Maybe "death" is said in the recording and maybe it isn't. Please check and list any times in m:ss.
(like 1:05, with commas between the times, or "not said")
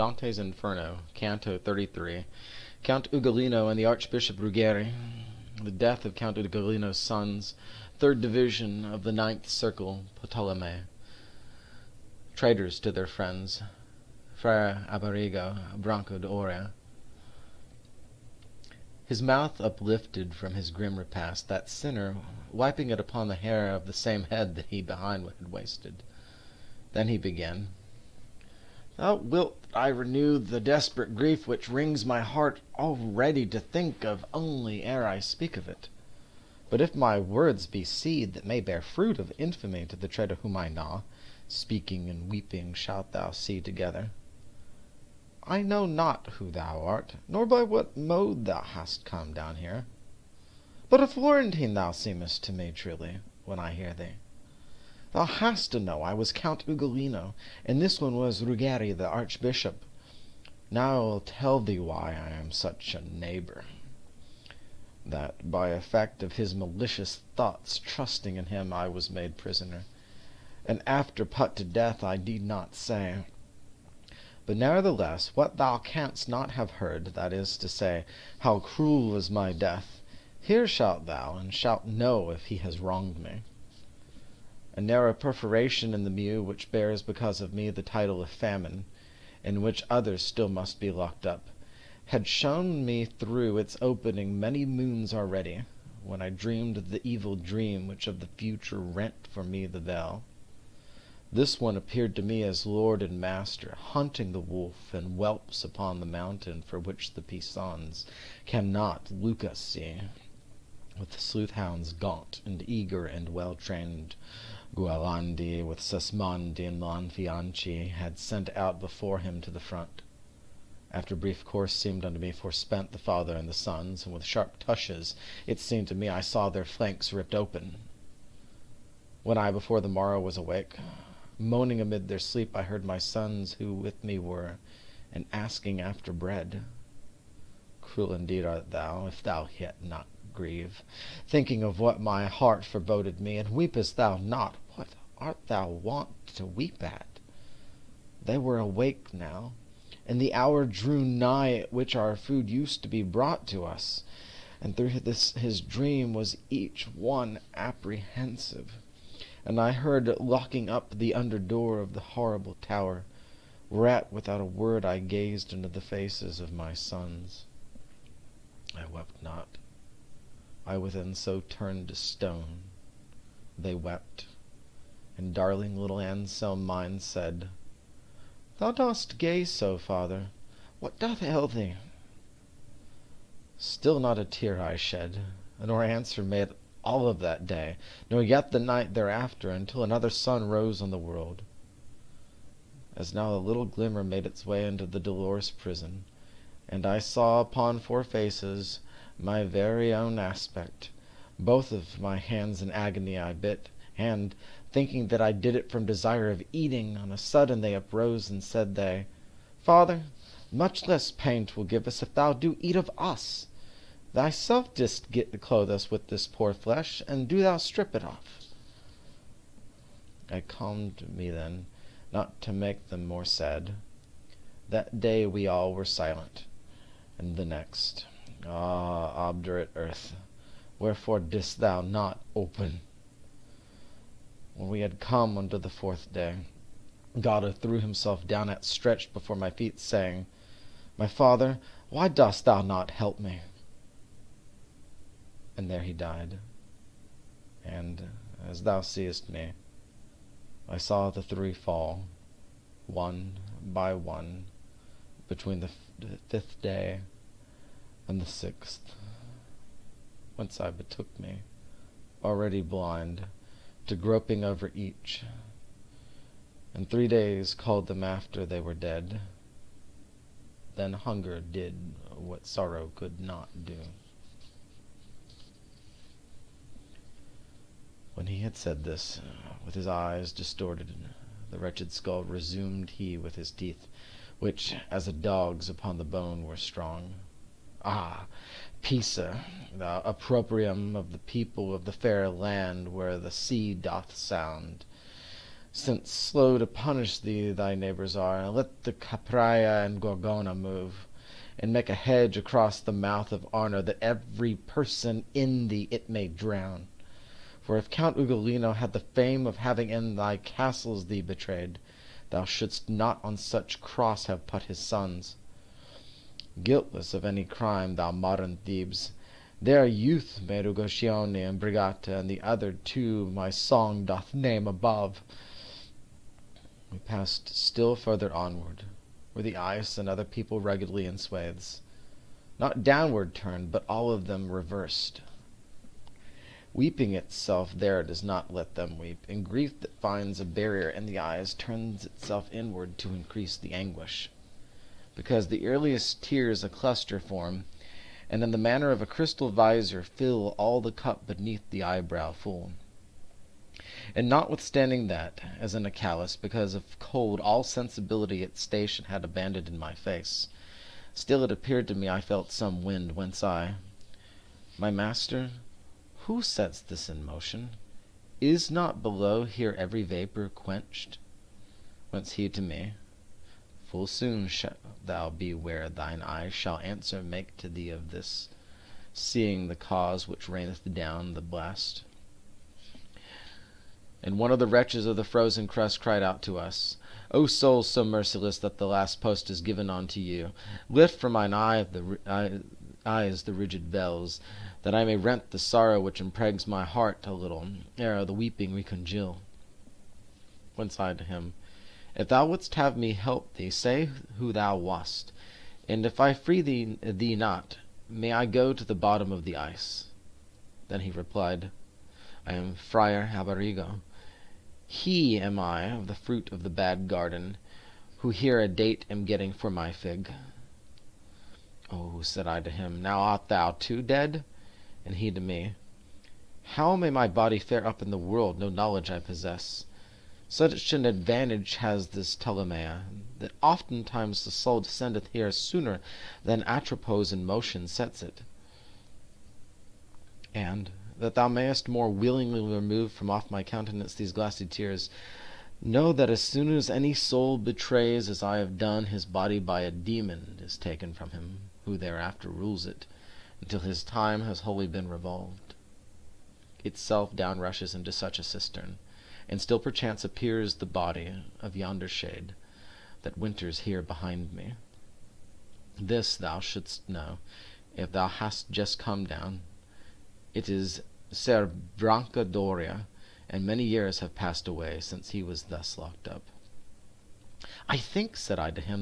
0:05, 1:11, 1:19.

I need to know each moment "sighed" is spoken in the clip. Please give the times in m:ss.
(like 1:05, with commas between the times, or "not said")
6:40.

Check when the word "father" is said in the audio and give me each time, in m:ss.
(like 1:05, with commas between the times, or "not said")
2:02, 2:59, 3:29, 4:01.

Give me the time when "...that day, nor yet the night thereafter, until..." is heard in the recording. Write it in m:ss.
3:07.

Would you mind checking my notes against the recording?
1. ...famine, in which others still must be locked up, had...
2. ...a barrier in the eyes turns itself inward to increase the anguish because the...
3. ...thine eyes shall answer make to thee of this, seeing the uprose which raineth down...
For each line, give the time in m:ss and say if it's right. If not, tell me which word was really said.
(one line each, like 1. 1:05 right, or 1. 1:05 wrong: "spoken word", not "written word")
1. 1:28 right
2. 5:40 right
3. 6:15 wrong: "cause", not "uprose".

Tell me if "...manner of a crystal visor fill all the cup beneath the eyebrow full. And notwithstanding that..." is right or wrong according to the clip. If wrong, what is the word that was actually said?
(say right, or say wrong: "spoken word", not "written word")
right.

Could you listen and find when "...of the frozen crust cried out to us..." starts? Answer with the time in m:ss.
6:25.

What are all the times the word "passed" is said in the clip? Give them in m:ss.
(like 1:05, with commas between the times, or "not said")
5:26, 7:54.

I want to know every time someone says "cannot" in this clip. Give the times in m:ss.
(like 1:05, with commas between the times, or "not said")
1:48.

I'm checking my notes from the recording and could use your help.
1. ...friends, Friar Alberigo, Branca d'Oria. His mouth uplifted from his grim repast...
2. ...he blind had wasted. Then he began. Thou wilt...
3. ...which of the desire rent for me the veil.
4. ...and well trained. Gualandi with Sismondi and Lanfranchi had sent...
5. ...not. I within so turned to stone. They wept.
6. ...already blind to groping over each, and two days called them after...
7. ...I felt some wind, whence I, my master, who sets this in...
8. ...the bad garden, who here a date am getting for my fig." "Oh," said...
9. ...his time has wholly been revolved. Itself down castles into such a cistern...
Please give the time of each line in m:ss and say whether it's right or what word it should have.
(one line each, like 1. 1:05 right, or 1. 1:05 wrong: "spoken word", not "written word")
1. 0:13 right
2. 0:24 wrong: "behind", not "blind"
3. 1:37 wrong: "future", not "desire"
4. 1:53 right
5. 2:49 right
6. 4:22 wrong: "three", not "two"
7. 6:02 right
8. 6:56 right
9. 7:33 wrong: "rushes", not "castles".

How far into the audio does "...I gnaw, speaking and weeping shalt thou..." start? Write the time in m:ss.
0:40.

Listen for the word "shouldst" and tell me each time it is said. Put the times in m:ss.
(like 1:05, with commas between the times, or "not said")
5:12, 7:46.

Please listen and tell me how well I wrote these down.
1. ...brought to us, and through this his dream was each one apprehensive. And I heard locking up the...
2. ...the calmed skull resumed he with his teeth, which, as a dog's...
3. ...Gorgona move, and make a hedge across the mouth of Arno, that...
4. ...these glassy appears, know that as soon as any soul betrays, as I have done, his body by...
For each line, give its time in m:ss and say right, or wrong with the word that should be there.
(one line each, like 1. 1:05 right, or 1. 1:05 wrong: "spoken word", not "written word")
1. 2:33 right
2. 4:41 wrong: "wretched", not "calmed"
3. 5:00 right
4. 7:24 wrong: "tears", not "appears".